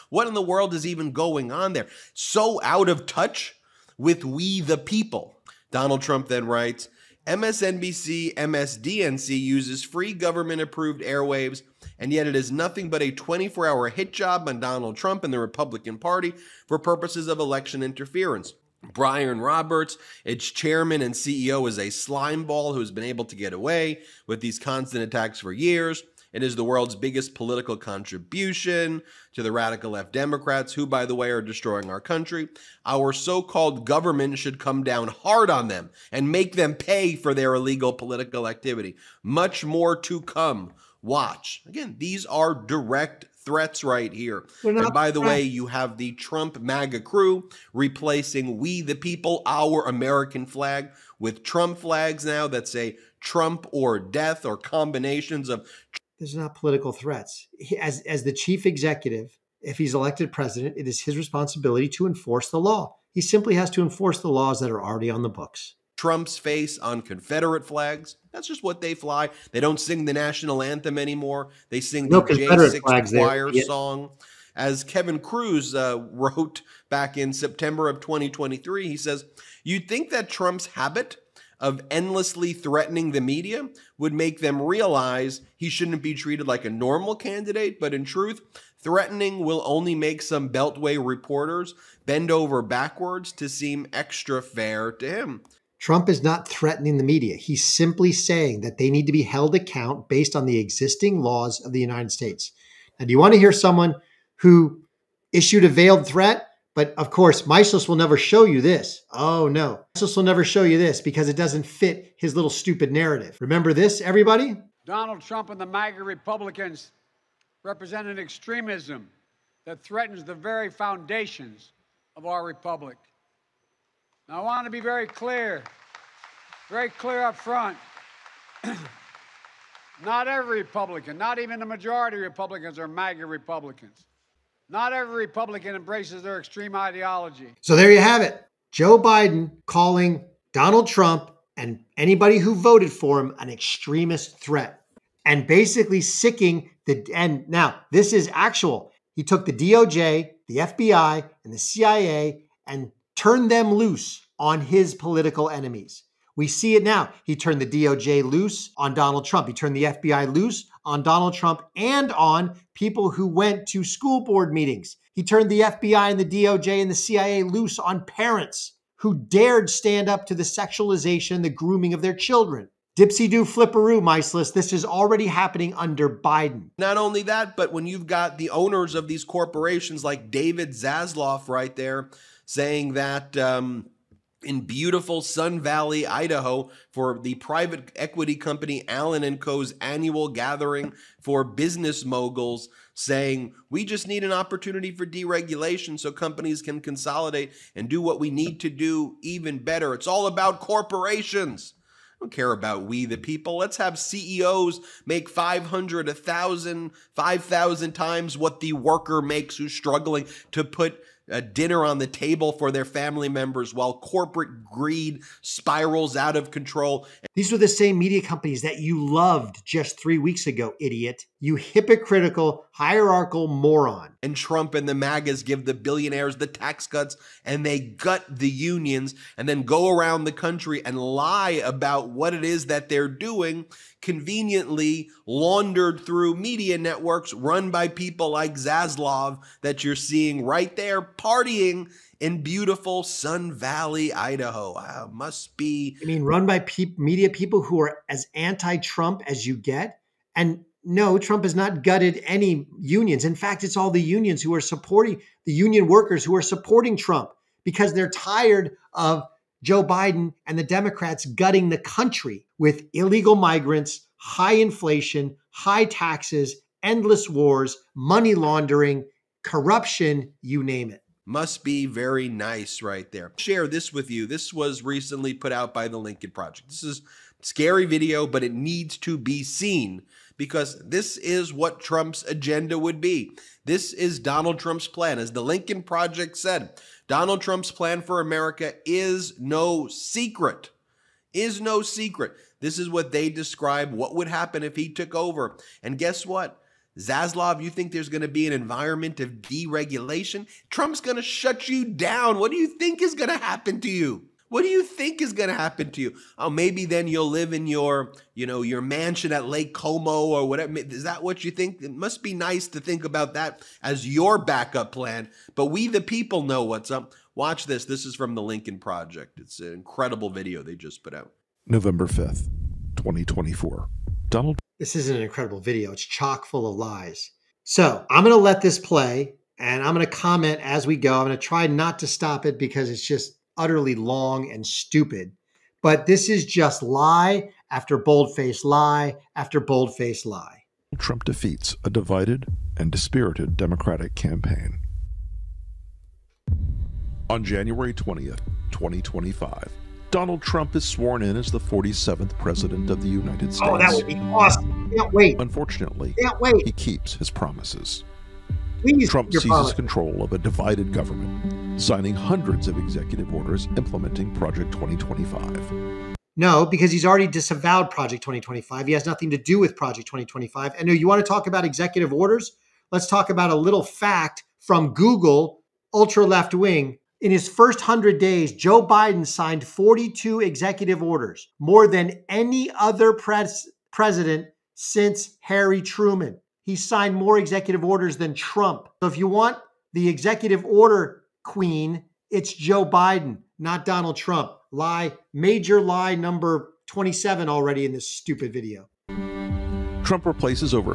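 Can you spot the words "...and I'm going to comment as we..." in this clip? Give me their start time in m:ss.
5:29.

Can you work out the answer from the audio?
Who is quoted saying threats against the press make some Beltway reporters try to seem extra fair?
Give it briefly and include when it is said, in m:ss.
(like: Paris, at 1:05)
Kevin Kruse, at 1:14.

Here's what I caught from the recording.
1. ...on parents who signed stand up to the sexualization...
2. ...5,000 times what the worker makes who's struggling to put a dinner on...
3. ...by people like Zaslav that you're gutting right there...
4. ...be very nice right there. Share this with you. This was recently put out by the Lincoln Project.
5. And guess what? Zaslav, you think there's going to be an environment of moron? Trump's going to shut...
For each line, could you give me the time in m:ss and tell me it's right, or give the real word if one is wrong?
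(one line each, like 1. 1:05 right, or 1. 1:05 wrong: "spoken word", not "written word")
1. 2:47 wrong: "dared", not "signed"
2. 3:27 right
3. 3:57 wrong: "seeing", not "gutting"
4. 4:31 right
5. 4:55 wrong: "deregulation", not "moron".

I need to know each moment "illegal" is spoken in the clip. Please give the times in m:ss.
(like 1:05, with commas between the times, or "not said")
0:37, 4:22.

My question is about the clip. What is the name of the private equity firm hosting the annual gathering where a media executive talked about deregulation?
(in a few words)
Allen and Co.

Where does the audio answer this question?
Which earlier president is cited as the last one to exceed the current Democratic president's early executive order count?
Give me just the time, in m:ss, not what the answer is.
6:25.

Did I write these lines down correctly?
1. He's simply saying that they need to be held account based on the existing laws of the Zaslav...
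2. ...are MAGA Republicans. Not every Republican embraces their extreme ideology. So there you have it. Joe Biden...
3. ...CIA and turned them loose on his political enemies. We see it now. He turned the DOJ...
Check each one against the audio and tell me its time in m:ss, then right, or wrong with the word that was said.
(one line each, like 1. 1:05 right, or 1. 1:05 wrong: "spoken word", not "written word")
1. 1:37 wrong: "United", not "Zaslav"
2. 2:12 right
3. 2:31 right.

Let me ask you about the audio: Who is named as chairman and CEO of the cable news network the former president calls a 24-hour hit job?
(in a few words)
Brian Roberts.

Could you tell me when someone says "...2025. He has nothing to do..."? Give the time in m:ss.
6:08.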